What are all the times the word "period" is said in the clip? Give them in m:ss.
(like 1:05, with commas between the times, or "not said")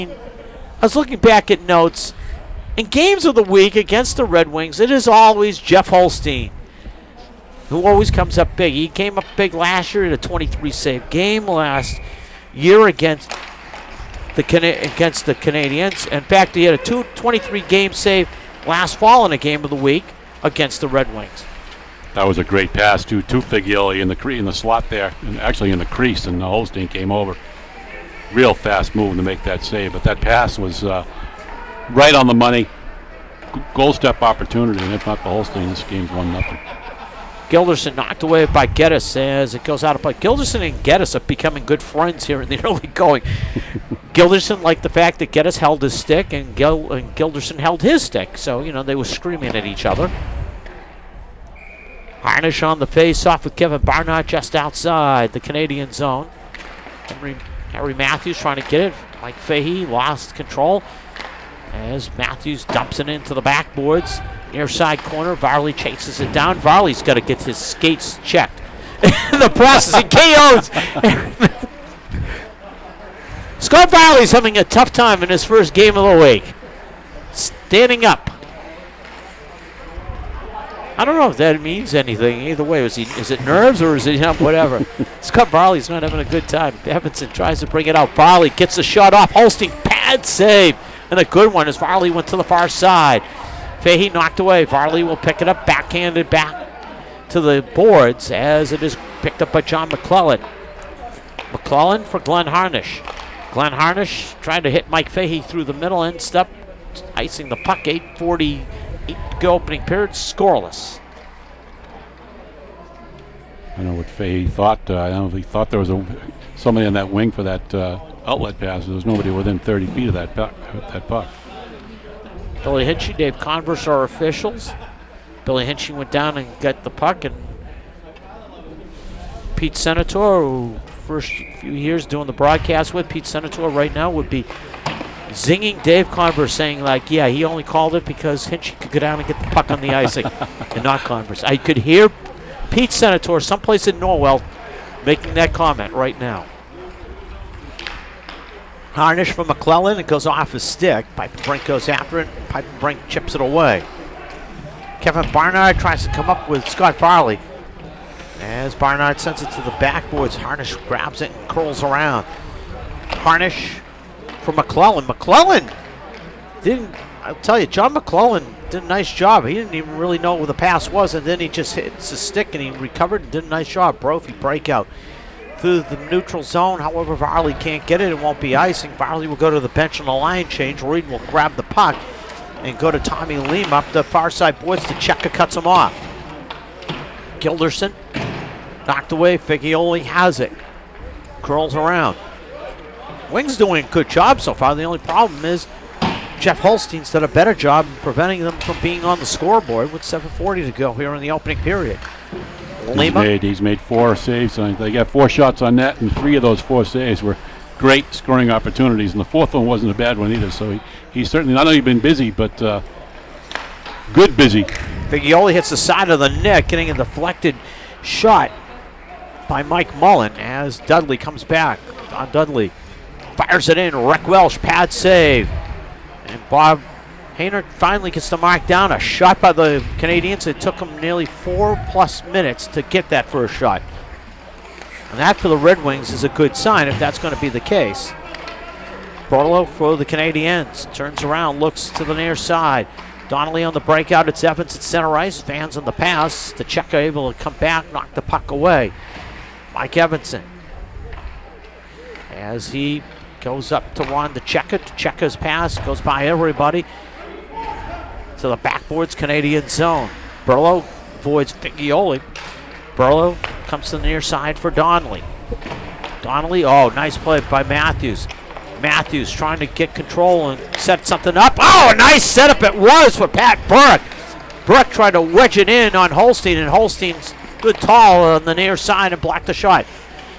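1:49, 3:21.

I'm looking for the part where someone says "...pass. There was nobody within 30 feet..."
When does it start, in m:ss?
1:58.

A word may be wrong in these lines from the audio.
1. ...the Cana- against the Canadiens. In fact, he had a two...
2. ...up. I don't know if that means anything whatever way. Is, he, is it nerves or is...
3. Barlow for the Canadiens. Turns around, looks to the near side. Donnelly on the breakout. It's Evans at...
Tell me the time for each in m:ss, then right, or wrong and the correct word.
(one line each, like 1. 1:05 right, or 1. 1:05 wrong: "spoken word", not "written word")
1. 0:14 right
2. 1:18 wrong: "either", not "whatever"
3. 3:59 right.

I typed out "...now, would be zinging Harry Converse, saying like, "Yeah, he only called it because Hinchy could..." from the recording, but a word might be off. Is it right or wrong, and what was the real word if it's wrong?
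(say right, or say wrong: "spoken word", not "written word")
wrong: "Dave", not "Harry".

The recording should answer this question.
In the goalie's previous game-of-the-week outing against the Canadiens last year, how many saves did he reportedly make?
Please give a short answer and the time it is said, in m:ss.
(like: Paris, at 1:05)
23, at 0:10.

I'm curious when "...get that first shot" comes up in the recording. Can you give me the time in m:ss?
3:52.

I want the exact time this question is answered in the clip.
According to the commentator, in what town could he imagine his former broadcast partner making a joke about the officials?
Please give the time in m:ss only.
2:23.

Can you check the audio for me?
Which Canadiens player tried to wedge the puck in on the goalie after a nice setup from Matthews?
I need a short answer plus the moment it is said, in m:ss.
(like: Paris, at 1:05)
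Pat Burke, at 4:33.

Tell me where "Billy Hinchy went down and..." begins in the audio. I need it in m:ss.
2:05.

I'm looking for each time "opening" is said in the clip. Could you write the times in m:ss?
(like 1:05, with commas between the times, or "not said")
1:49, 3:21.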